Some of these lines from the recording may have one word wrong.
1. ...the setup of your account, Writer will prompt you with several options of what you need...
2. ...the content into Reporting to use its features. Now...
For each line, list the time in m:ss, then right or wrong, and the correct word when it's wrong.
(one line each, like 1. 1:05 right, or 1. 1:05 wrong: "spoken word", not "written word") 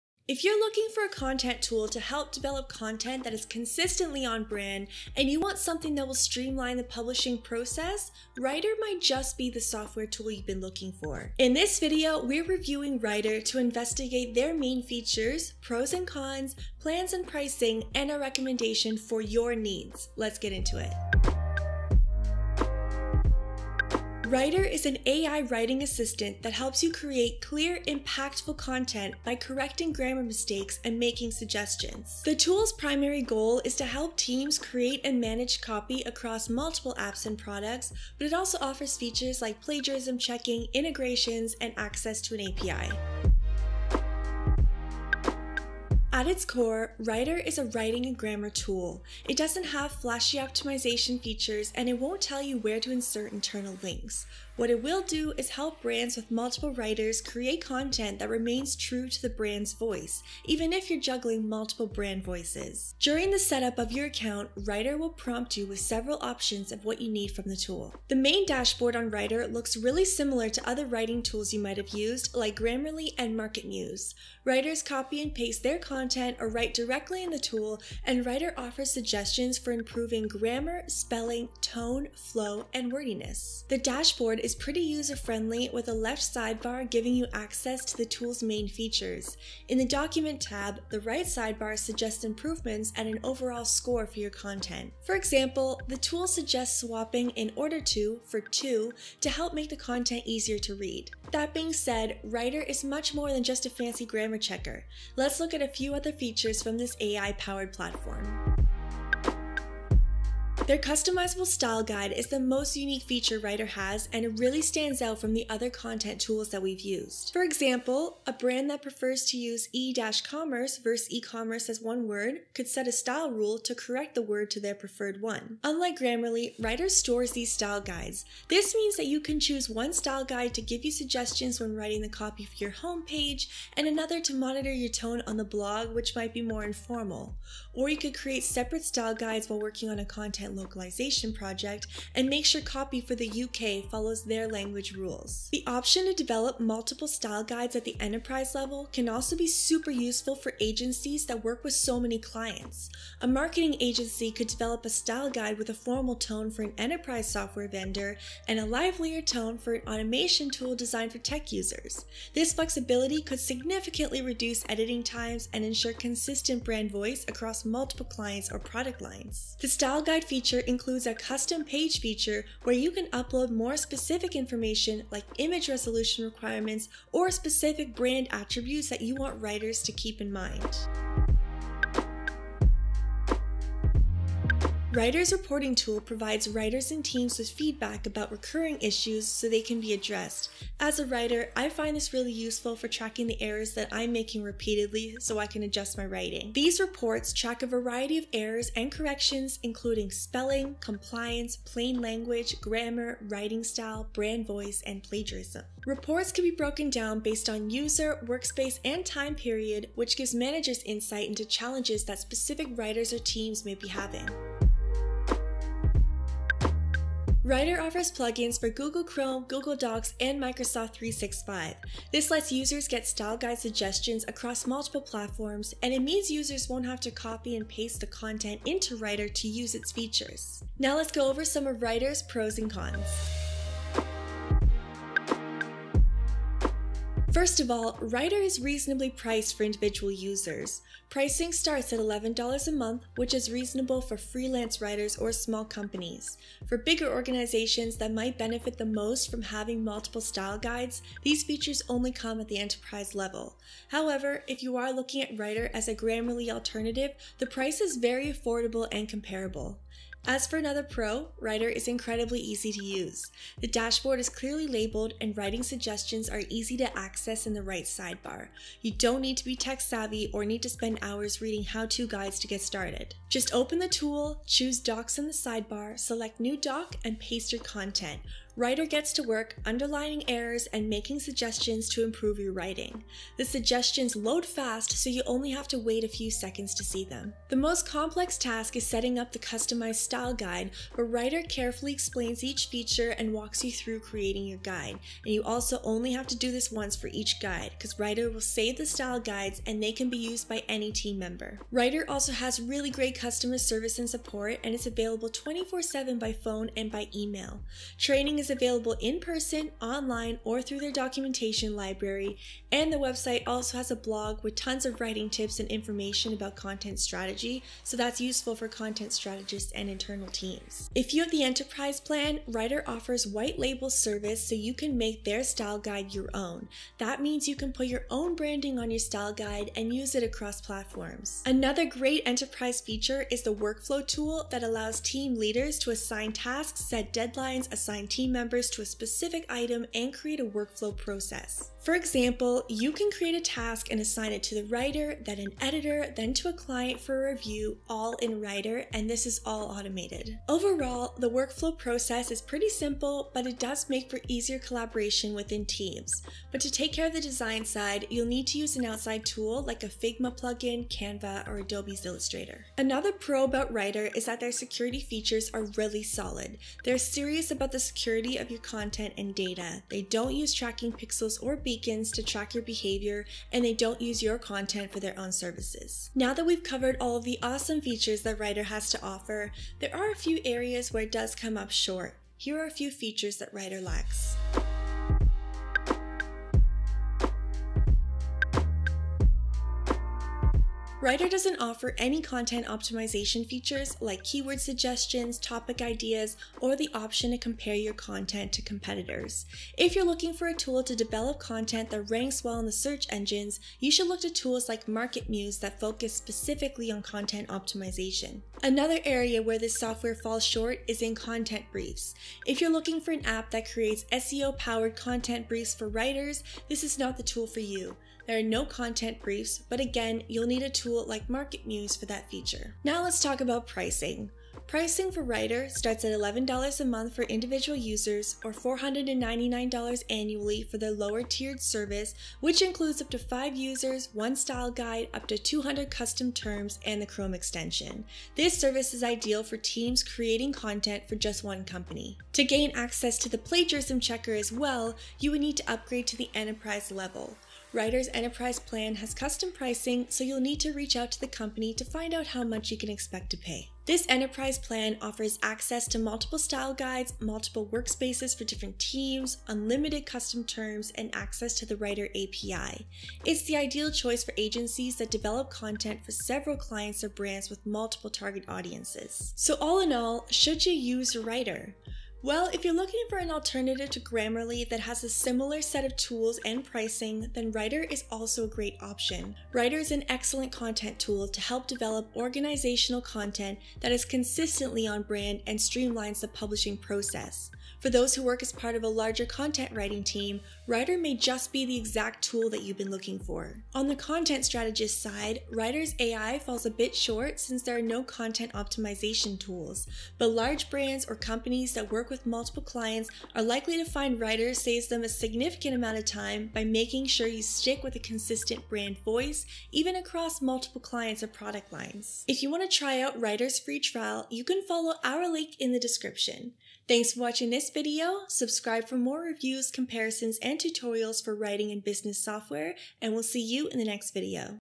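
1. 1:03 right
2. 3:47 wrong: "Writer", not "Reporting".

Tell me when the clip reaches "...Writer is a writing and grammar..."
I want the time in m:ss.
0:46.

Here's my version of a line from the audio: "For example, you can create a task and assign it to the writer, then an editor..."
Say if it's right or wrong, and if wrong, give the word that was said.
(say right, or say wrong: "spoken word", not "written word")
right.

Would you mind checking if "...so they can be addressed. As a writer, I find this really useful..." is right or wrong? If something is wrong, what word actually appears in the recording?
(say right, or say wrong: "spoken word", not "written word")
right.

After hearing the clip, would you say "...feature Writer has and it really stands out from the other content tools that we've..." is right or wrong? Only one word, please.
right.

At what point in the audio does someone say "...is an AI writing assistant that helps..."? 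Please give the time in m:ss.
0:24.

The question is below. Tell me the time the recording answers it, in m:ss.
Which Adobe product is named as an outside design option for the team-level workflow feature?
6:02.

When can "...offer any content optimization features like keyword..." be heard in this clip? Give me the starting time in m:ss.
6:31.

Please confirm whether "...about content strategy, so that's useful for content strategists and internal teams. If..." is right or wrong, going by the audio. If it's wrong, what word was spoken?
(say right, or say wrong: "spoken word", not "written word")
right.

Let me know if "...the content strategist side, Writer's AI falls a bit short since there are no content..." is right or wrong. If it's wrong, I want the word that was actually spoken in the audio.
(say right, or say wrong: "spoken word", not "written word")
right.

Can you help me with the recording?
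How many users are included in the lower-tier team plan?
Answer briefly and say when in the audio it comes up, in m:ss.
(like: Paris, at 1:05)
5, at 7:13.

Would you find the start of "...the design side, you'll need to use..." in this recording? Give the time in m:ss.
5:57.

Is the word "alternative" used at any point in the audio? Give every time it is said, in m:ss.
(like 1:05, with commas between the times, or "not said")
4:16, 7:53.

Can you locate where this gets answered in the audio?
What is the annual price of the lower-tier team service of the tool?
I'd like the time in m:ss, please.
7:08.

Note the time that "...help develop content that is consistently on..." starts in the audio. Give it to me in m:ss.
0:01.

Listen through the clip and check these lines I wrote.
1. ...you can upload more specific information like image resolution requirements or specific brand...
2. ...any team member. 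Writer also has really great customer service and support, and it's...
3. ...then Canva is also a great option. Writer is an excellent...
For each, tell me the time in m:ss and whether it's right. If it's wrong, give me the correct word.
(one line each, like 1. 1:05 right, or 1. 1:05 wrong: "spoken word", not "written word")
1. 2:52 right
2. 5:00 right
3. 7:57 wrong: "Writer", not "Canva".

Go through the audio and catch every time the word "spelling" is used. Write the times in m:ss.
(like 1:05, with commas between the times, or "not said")
1:20, 3:20.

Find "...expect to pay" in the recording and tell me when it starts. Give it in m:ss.
7:32.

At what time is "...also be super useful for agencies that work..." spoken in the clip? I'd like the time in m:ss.
2:29.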